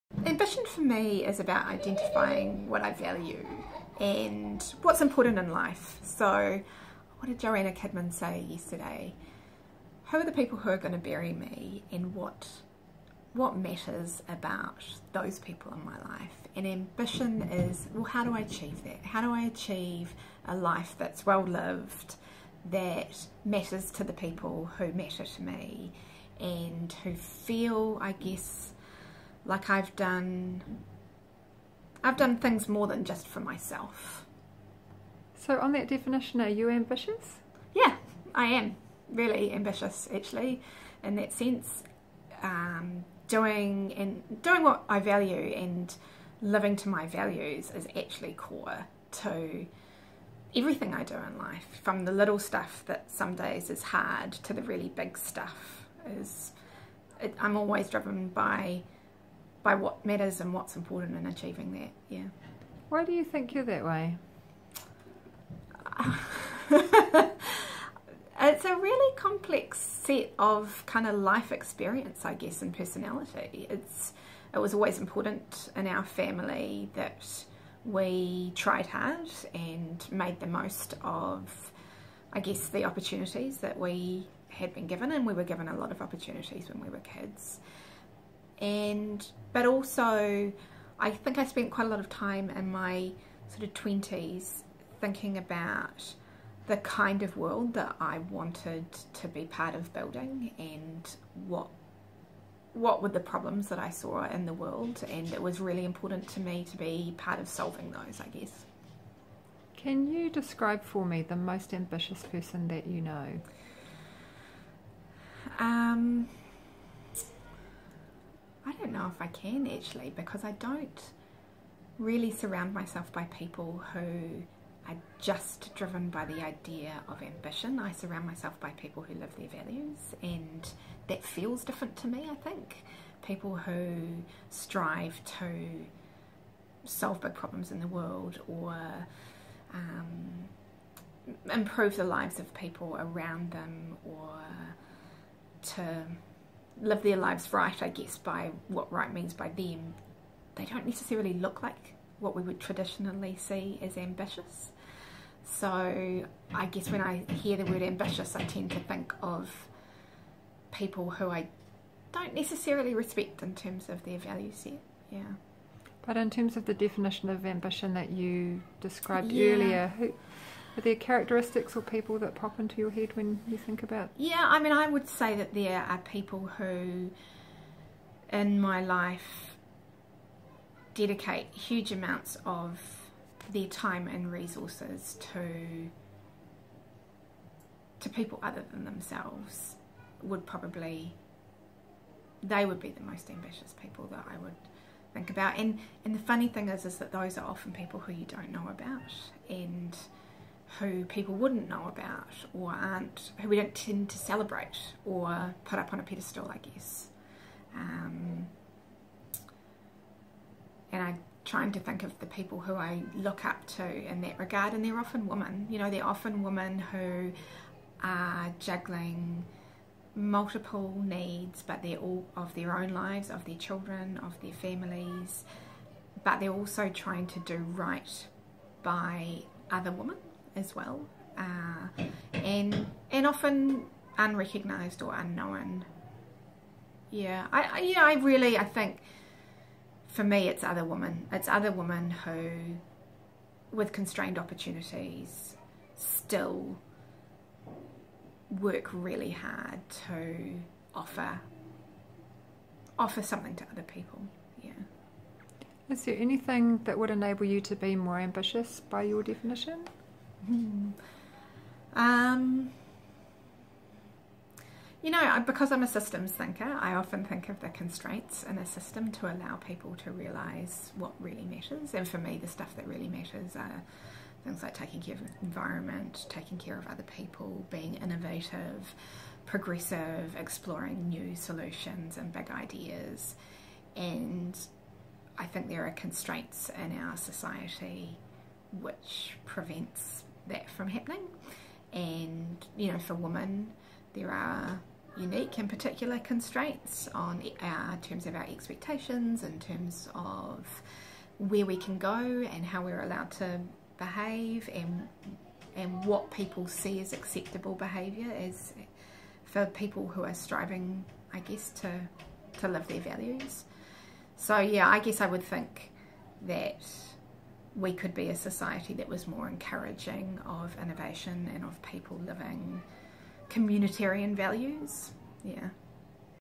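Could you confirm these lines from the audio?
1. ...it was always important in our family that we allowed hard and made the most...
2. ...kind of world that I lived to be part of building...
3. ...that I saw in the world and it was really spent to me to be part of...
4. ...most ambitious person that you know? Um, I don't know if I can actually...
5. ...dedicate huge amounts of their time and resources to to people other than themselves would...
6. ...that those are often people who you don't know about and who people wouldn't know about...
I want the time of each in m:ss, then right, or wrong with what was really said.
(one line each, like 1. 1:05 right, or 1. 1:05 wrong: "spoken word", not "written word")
1. 1:14 wrong: "tried", not "allowed"
2. 1:36 wrong: "wanted", not "lived"
3. 1:43 wrong: "important", not "spent"
4. 1:51 right
5. 3:00 right
6. 3:16 right.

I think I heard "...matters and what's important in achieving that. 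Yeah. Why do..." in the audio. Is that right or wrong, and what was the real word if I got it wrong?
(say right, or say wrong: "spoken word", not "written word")
right.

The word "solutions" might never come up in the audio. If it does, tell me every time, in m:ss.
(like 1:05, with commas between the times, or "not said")
4:41.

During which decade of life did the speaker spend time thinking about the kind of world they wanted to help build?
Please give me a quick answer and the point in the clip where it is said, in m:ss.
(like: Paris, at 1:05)
20s, at 1:33.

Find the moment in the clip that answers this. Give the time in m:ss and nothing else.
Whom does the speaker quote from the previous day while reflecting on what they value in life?
0:07.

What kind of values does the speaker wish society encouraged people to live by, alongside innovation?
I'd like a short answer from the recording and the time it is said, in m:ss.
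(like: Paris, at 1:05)
communitarian values, at 5:23.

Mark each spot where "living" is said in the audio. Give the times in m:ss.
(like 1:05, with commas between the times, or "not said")
0:46, 5:22.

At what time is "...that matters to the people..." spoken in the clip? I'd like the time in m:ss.
0:22.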